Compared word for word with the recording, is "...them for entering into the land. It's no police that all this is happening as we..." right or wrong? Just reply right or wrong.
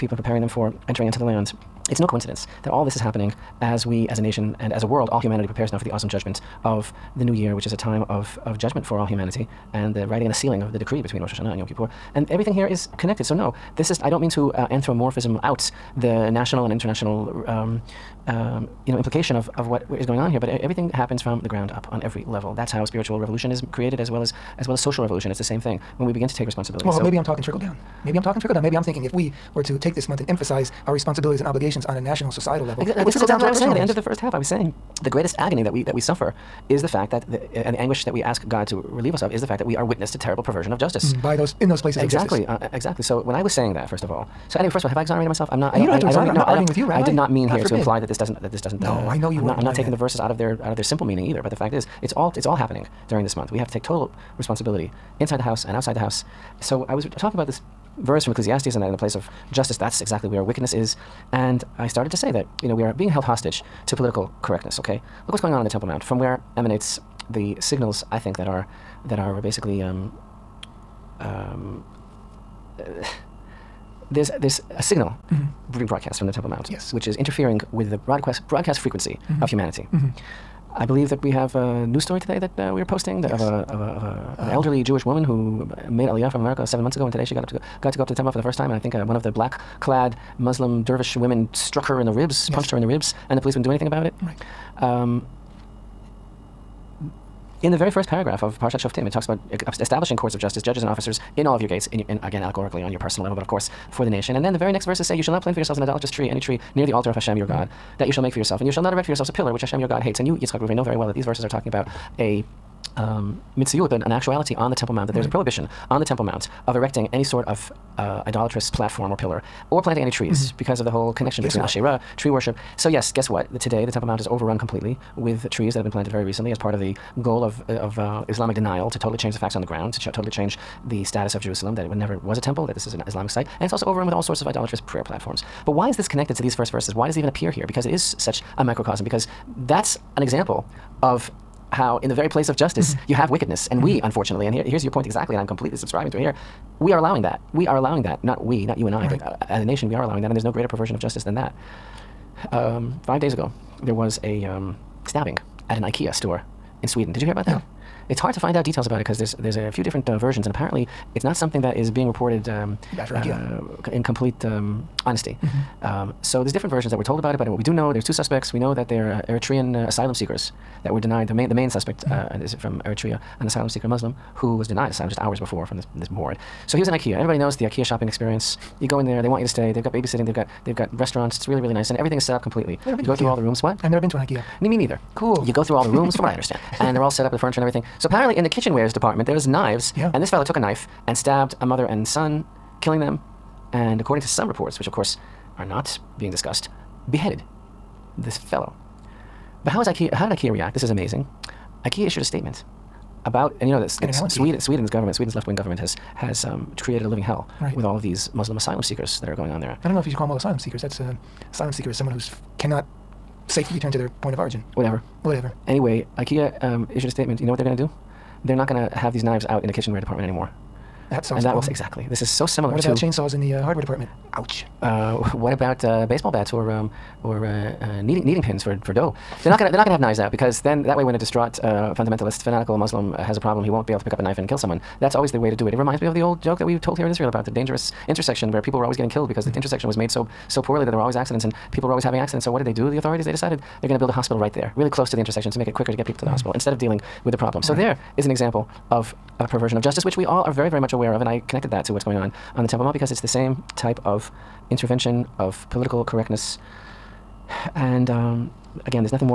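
wrong.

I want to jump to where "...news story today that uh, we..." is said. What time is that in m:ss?
1:21.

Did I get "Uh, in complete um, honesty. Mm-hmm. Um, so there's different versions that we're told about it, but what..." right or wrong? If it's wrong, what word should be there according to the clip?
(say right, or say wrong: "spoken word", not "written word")
right.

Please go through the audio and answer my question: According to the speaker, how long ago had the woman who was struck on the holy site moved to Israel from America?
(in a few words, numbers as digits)
7 months.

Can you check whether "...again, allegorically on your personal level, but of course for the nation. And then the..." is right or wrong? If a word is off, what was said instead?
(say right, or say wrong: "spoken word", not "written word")
right.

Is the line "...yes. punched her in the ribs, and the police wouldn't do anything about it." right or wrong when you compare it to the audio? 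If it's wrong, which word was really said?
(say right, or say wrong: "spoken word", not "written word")
right.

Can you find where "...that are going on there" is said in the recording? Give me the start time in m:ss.
3:29.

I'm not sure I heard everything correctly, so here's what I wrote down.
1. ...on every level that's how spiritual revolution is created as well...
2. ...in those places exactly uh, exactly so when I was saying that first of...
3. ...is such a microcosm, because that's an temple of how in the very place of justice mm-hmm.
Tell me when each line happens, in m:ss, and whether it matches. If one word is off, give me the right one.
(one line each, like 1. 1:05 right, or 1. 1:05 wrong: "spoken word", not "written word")
1. 0:21 right
2. 0:41 right
3. 2:17 wrong: "example", not "temple".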